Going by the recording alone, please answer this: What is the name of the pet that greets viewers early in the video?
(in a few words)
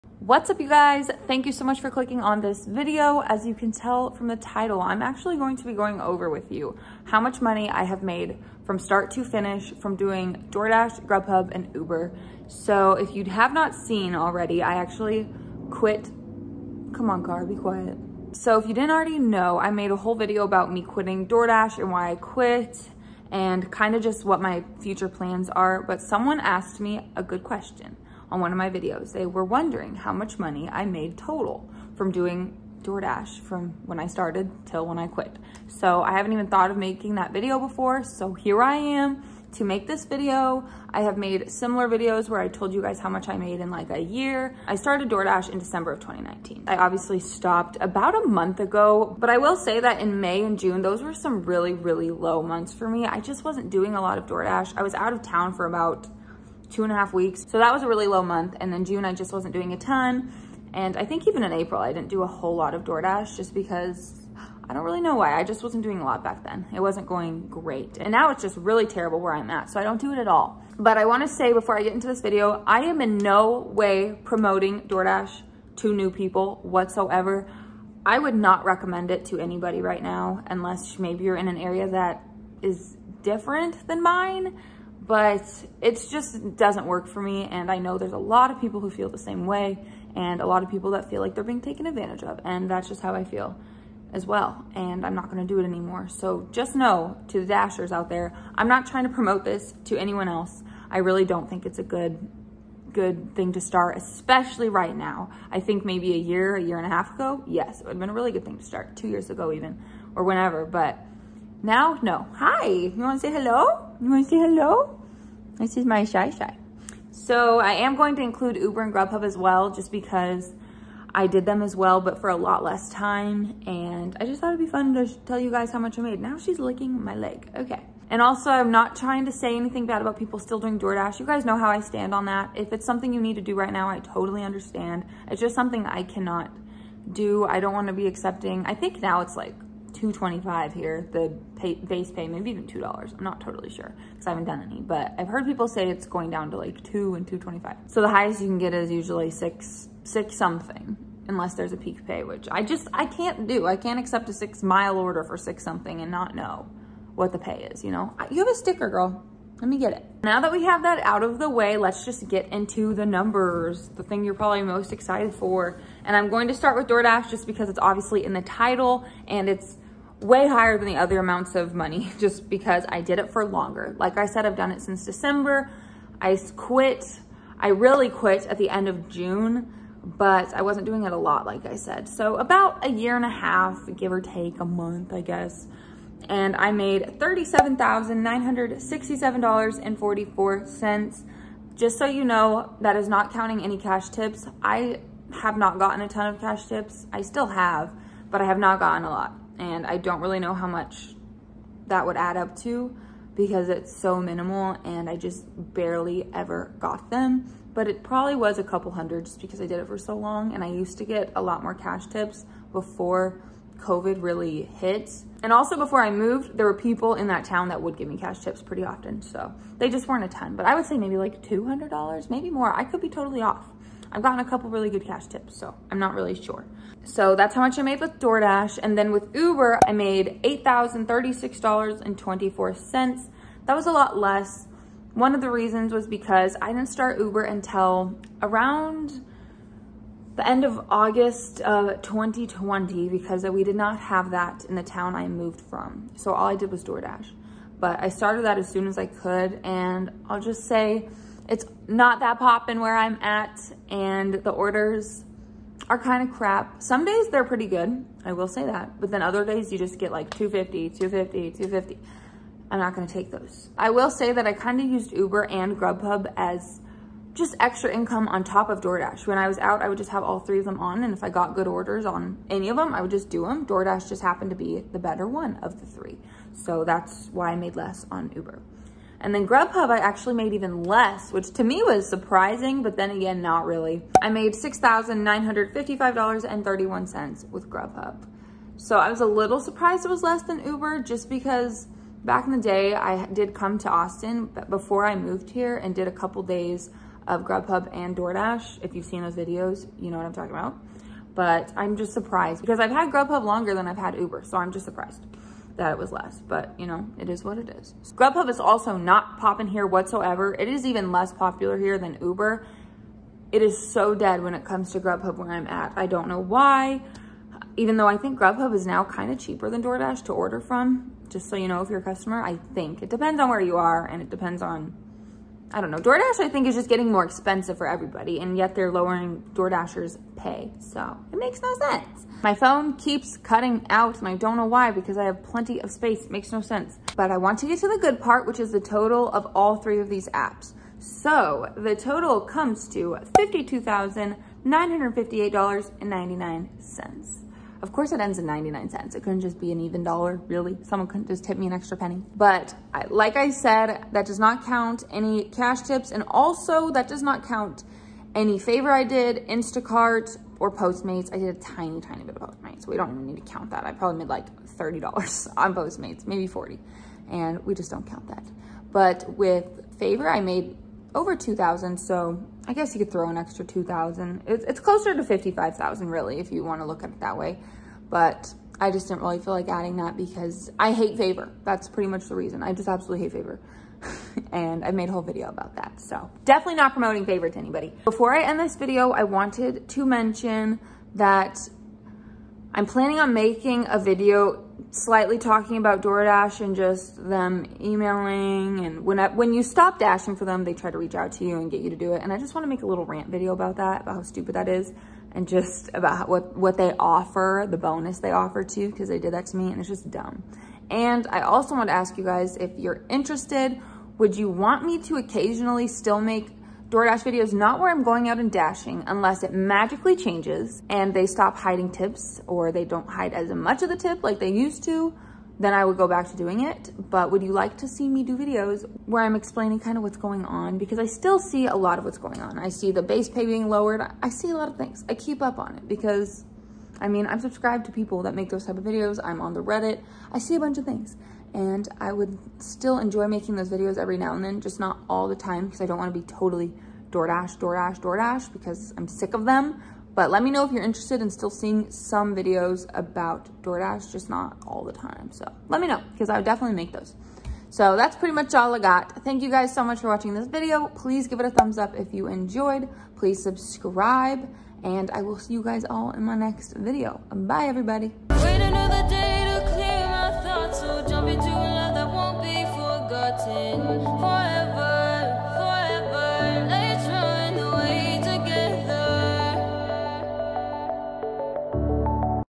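Shy Shy.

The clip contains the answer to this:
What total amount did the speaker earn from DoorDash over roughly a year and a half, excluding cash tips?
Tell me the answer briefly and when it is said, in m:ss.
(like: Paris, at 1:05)
$37,967.44, at 3:07.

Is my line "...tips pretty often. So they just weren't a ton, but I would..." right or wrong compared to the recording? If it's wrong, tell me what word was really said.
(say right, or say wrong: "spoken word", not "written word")
right.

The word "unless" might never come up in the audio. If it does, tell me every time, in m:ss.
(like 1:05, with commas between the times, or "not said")
1:20, 2:31, 6:59.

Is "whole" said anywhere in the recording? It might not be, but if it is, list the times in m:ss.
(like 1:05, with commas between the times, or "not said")
0:19, 1:02, 6:25.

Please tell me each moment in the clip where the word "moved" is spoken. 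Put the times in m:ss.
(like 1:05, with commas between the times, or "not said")
3:36, 4:05, 4:55.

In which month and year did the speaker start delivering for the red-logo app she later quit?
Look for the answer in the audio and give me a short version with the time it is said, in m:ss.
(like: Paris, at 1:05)
December 2019, at 0:45.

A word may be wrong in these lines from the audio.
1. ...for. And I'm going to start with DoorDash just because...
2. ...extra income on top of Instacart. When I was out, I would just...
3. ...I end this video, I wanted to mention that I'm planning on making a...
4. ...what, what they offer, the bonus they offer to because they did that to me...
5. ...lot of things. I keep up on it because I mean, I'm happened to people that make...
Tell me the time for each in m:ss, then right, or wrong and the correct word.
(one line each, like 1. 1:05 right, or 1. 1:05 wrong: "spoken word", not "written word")
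1. 2:45 right
2. 4:27 wrong: "DoorDash", not "Instacart"
3. 6:28 right
4. 6:46 right
5. 7:14 wrong: "subscribed", not "happened".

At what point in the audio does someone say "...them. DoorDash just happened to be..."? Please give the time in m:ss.
4:33.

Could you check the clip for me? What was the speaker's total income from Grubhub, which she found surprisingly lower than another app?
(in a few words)
$6,955.31.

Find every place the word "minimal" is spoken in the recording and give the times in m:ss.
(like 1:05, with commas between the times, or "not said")
3:24.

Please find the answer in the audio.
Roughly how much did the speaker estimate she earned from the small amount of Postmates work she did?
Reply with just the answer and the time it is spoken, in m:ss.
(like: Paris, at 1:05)
$30, at 6:04.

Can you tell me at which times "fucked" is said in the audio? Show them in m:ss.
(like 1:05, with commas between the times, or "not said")
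not said.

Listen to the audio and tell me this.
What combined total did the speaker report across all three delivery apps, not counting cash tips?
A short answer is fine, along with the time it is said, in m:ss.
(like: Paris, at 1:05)
$52,958.99, at 5:43.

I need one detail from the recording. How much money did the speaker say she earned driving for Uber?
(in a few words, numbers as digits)
$8,036.24.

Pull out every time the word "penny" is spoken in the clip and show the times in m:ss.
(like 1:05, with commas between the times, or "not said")
5:51.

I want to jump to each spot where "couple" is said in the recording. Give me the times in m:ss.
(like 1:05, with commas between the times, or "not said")
3:28, 3:44, 4:56.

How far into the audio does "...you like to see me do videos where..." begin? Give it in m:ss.
7:07.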